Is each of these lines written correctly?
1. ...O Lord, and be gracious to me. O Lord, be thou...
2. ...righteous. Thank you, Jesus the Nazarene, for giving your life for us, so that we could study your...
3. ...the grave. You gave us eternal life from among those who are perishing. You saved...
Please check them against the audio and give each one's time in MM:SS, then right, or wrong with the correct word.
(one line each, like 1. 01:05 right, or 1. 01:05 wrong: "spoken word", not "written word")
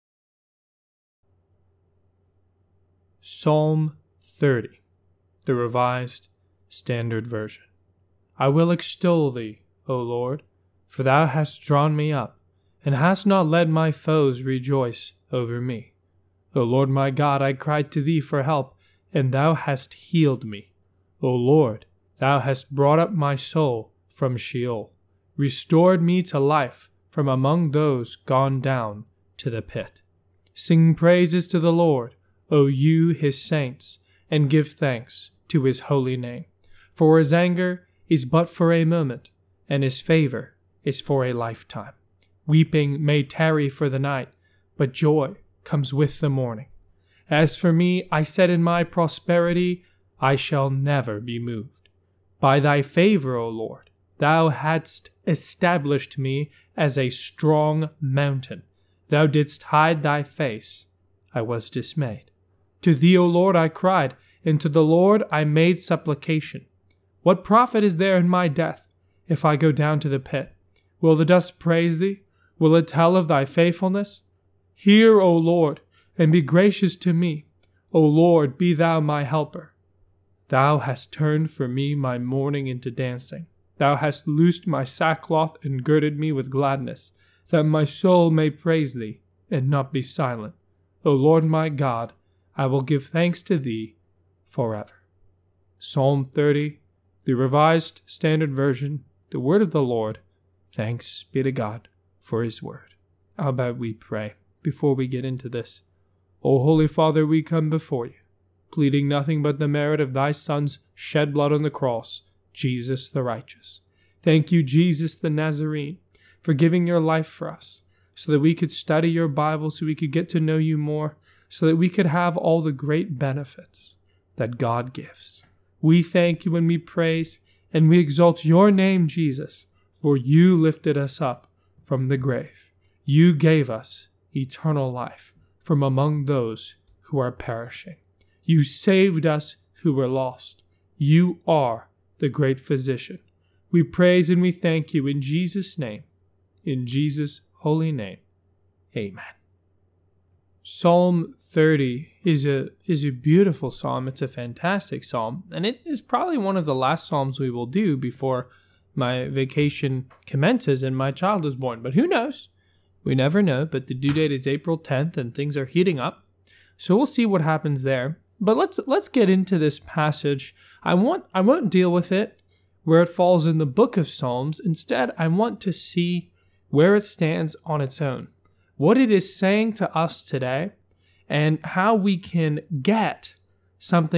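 1. 01:15 right
2. 01:53 right
3. 02:12 right.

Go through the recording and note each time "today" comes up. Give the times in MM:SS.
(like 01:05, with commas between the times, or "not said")
03:00.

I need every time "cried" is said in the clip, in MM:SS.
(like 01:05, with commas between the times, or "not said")
00:17, 01:03.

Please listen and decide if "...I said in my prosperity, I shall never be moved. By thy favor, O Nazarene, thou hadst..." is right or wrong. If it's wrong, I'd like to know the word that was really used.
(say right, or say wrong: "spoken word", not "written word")
wrong: "Lord", not "Nazarene".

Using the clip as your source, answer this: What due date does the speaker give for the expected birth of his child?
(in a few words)
April 10.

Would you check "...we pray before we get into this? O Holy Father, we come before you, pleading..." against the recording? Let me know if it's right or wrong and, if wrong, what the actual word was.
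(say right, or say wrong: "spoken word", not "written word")
right.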